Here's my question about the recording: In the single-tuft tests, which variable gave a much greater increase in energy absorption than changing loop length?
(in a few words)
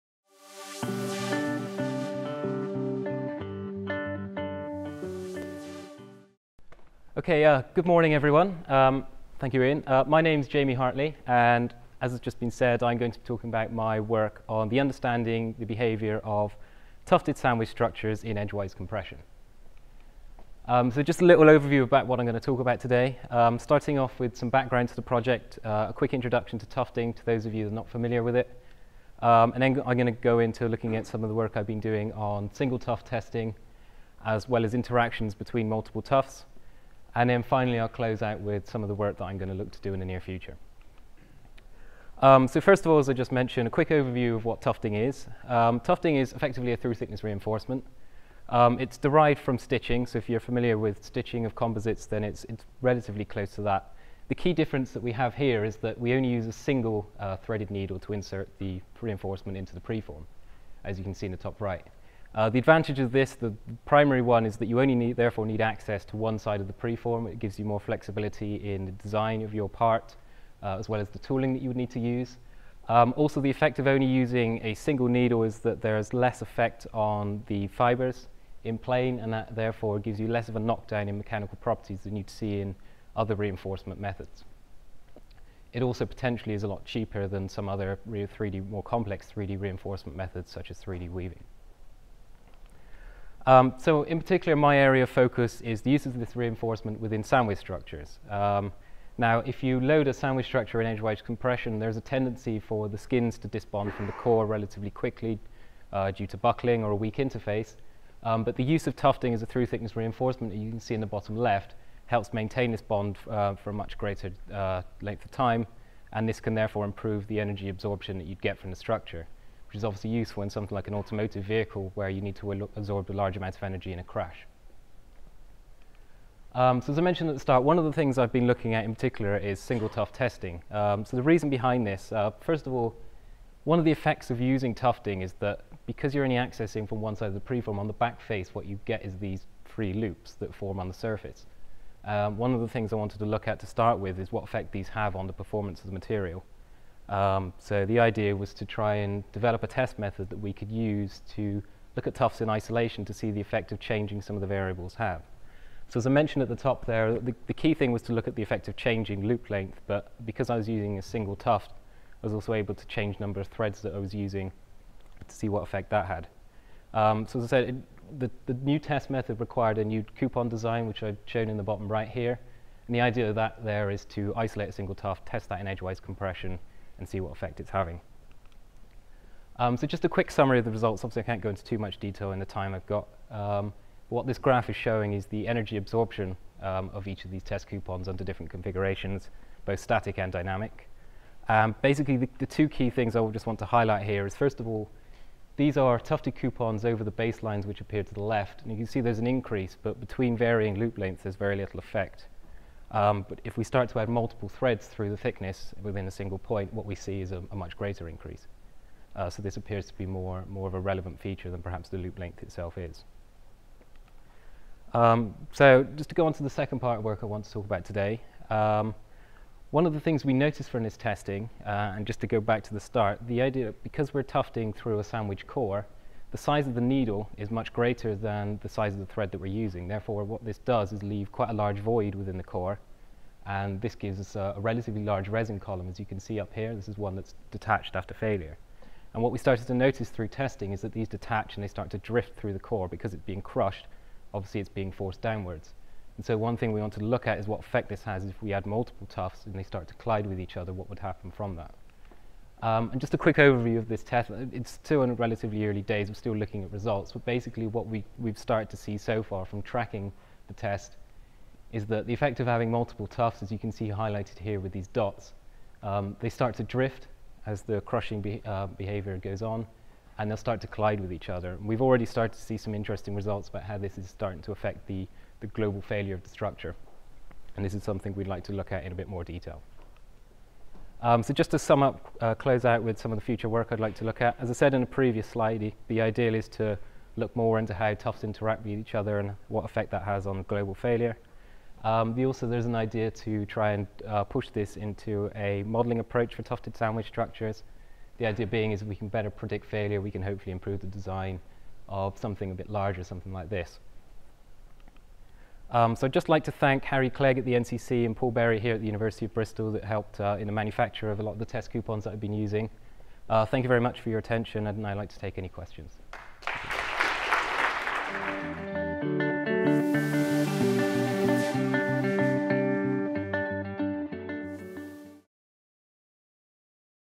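Multiple threads.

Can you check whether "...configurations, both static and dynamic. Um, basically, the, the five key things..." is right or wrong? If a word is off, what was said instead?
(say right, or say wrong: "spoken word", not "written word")
wrong: "two", not "five".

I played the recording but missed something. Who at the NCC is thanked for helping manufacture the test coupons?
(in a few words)
Harry Clegg.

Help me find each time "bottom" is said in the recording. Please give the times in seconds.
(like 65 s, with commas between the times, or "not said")
111 s, 171 s.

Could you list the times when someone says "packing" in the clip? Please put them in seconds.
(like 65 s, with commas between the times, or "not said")
not said.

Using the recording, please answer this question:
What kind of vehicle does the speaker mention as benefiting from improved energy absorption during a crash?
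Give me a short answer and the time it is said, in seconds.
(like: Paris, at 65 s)
Automotive vehicle, at 120 s.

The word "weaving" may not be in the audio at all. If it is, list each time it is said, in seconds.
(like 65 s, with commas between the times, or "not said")
91 s.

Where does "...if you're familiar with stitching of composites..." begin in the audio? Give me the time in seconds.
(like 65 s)
50 s.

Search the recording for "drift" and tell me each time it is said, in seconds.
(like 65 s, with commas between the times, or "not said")
241 s, 266 s.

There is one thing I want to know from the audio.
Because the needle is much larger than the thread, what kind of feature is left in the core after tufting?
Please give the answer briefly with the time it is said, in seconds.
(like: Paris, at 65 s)
Resin column, at 235 s.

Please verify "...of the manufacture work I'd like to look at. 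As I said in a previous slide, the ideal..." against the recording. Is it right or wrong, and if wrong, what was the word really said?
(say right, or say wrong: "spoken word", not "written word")
wrong: "future", not "manufacture".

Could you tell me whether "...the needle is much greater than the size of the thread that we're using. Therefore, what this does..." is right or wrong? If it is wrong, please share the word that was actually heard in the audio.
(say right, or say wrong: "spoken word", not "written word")
right.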